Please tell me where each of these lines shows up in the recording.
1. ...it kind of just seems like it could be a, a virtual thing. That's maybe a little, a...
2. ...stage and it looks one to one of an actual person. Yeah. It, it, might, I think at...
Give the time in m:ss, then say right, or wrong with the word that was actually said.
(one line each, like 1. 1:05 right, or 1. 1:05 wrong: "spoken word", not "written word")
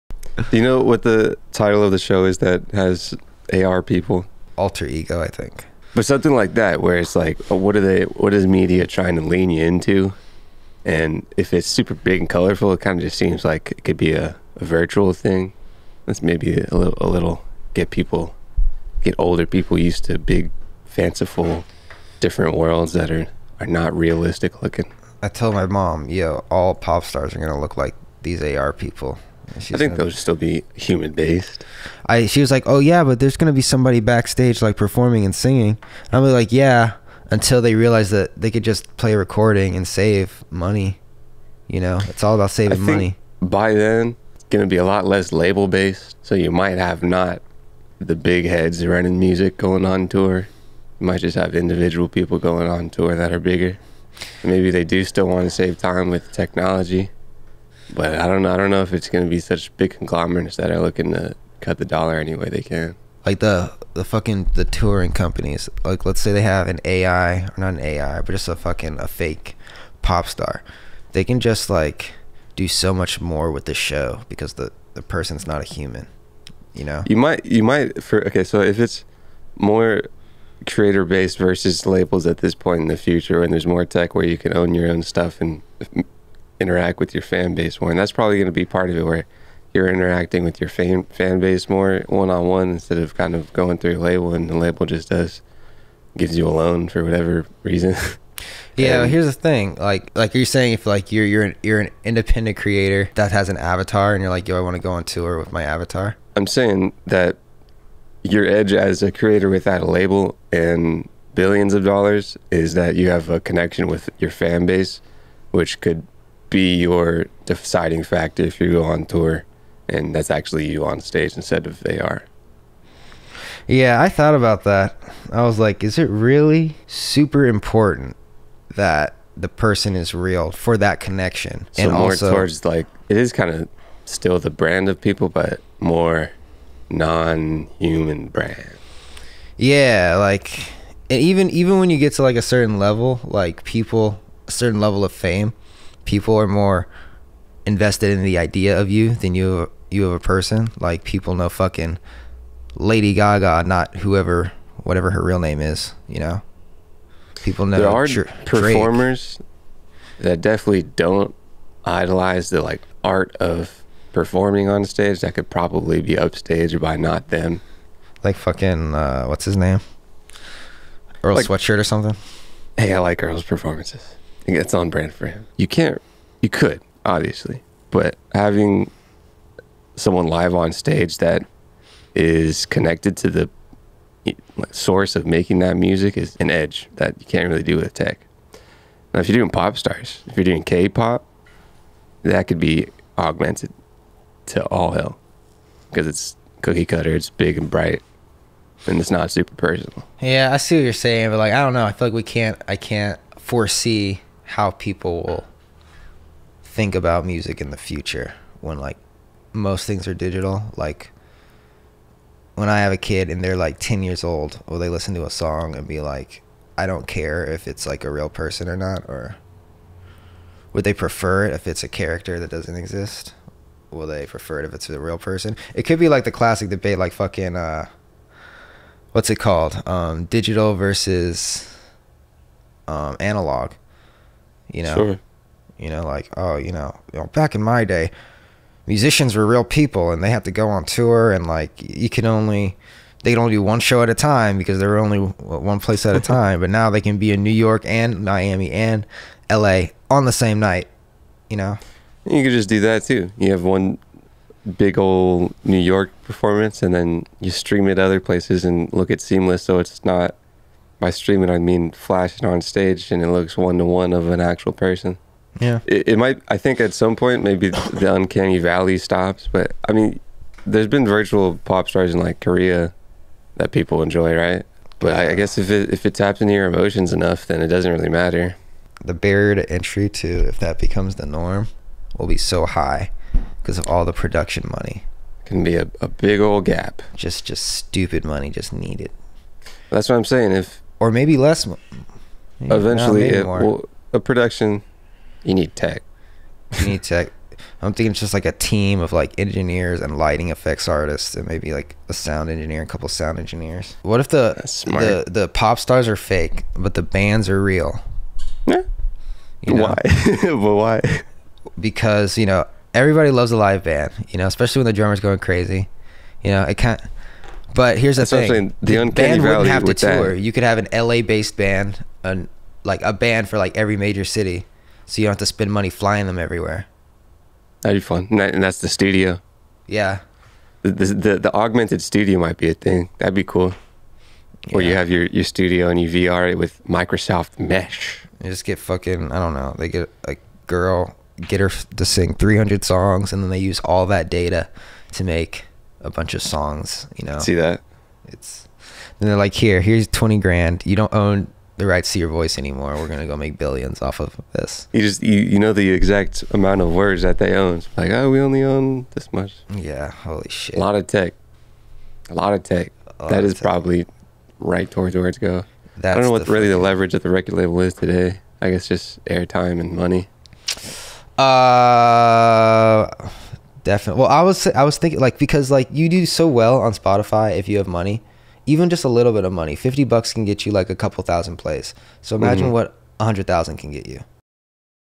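1. 0:12 right
2. 4:22 right.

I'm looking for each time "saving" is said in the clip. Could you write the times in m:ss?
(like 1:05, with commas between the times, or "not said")
0:42.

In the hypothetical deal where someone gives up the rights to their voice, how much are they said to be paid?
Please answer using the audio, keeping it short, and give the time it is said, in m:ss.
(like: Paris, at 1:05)
$20,000, at 5:50.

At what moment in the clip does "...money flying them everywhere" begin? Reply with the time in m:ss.
5:25.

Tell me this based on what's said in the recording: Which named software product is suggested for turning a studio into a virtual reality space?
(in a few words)
Microsoft Mesh.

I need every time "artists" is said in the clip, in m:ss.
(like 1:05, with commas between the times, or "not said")
5:00.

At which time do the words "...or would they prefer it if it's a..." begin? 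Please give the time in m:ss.
3:39.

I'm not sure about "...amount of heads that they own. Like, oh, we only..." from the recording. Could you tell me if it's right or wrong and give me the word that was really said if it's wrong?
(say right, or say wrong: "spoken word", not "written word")
wrong: "words", not "heads".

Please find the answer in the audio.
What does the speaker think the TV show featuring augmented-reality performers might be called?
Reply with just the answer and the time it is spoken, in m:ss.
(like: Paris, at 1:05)
Alter Ego, at 0:04.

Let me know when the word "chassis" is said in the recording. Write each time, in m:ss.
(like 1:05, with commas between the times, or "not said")
not said.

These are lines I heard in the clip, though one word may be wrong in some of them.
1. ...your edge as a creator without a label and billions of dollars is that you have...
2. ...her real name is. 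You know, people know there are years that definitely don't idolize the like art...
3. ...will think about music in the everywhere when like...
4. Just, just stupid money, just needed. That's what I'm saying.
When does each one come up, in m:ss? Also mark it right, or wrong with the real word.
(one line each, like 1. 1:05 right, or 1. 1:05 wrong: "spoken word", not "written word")
1. 1:48 right
2. 2:35 wrong: "performers", not "years"
3. 3:25 wrong: "future", not "everywhere"
4. 4:47 right.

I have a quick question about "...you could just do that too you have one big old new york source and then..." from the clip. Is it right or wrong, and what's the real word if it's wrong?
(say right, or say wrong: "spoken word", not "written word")
wrong: "performance", not "source".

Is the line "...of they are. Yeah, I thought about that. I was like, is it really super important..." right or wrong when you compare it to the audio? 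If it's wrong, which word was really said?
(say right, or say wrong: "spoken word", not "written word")
right.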